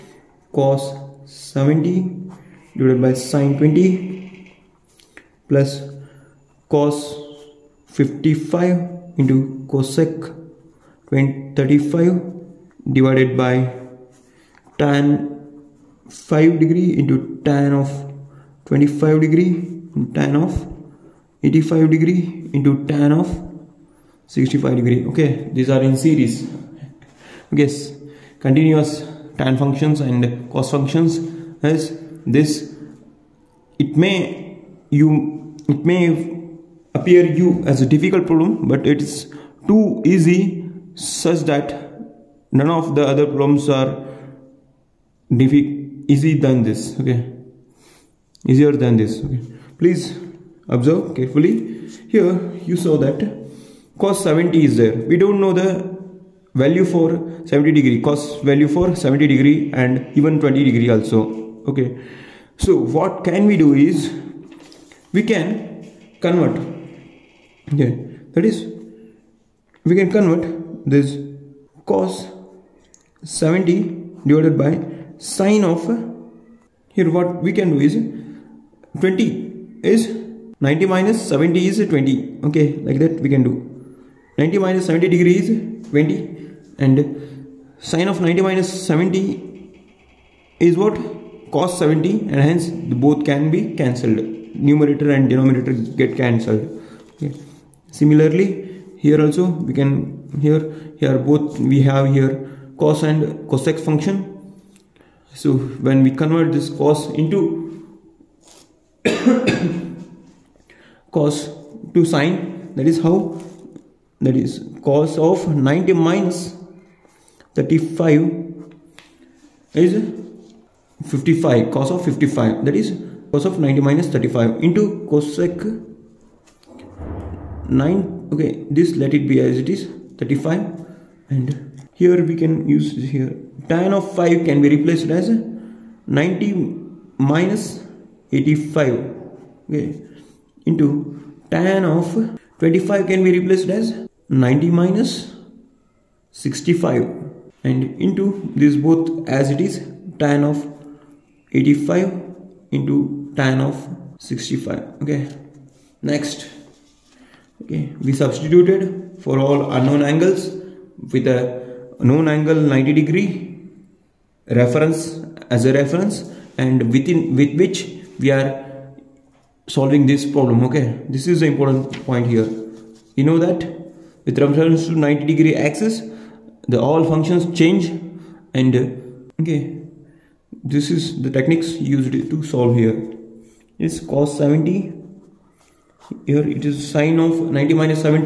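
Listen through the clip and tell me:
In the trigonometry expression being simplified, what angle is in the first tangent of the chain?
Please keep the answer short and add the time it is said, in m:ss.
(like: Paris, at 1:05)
5 degrees, at 0:14.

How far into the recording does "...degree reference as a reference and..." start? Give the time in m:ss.
2:43.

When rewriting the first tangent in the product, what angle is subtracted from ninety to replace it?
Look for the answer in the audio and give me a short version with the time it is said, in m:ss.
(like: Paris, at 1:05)
85, at 2:16.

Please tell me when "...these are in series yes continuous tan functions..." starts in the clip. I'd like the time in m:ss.
0:25.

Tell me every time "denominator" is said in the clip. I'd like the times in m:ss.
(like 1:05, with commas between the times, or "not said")
1:35.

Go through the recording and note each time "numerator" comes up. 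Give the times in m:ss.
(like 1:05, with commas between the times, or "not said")
1:34.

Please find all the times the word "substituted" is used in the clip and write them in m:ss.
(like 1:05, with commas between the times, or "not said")
2:38.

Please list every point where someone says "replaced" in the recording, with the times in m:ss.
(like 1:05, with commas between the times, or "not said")
2:14, 2:23.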